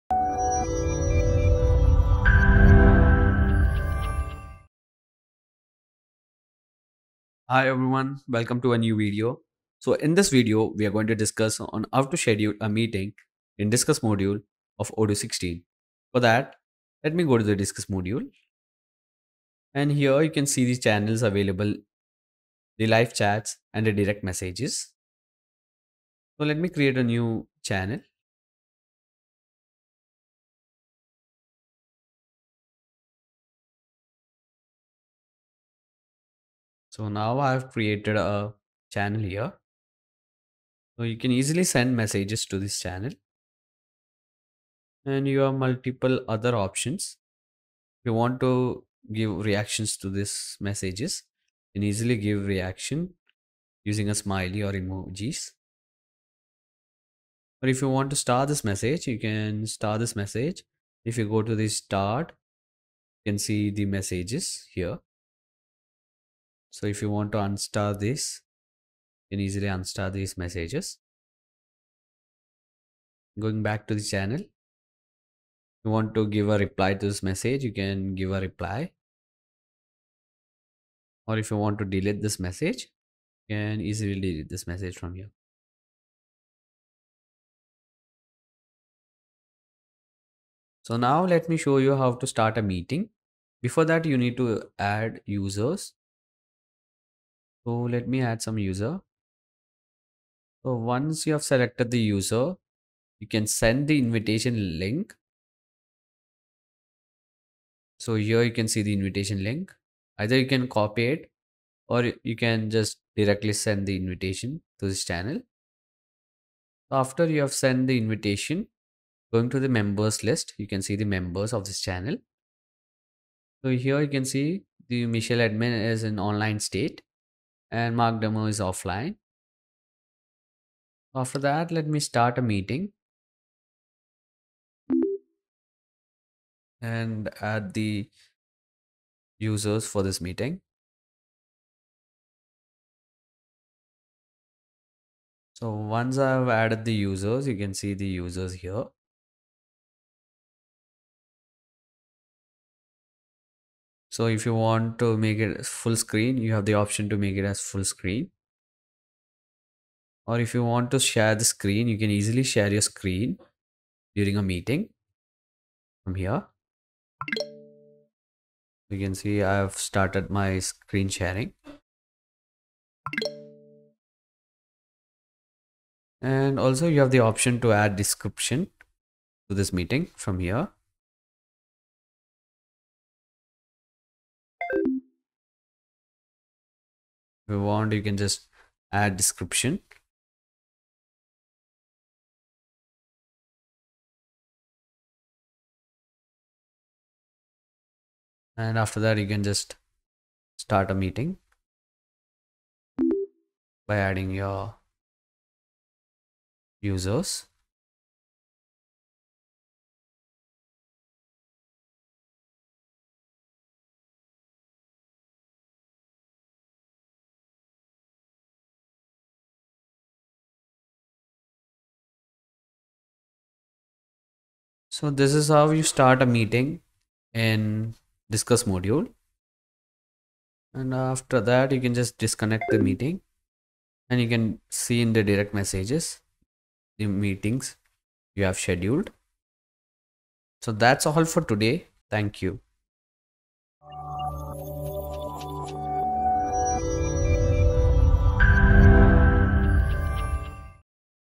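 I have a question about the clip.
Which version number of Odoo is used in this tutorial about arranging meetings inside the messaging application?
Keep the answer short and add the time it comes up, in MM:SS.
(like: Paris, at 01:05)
16, at 00:14.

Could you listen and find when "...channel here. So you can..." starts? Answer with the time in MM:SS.
00:38.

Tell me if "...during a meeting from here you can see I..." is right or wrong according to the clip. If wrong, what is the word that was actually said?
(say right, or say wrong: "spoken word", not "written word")
right.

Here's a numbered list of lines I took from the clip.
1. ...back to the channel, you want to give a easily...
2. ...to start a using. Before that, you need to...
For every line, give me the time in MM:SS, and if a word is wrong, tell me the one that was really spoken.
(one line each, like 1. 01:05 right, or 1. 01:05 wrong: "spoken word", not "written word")
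1. 01:13 wrong: "reply", not "easily"
2. 01:32 wrong: "meeting", not "using".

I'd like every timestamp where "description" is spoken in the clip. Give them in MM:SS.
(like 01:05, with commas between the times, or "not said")
02:57, 03:09.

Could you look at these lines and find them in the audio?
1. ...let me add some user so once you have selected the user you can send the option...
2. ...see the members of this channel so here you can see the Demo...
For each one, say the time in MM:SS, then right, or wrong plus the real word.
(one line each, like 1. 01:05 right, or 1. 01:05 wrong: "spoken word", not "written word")
1. 01:37 wrong: "invitation", not "option"
2. 02:00 wrong: "Mitchell", not "Demo".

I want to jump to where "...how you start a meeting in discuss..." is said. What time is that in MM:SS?
03:45.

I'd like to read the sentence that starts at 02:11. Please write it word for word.
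After that, let me start a meeting.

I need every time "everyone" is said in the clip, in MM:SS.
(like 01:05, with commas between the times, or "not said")
00:07.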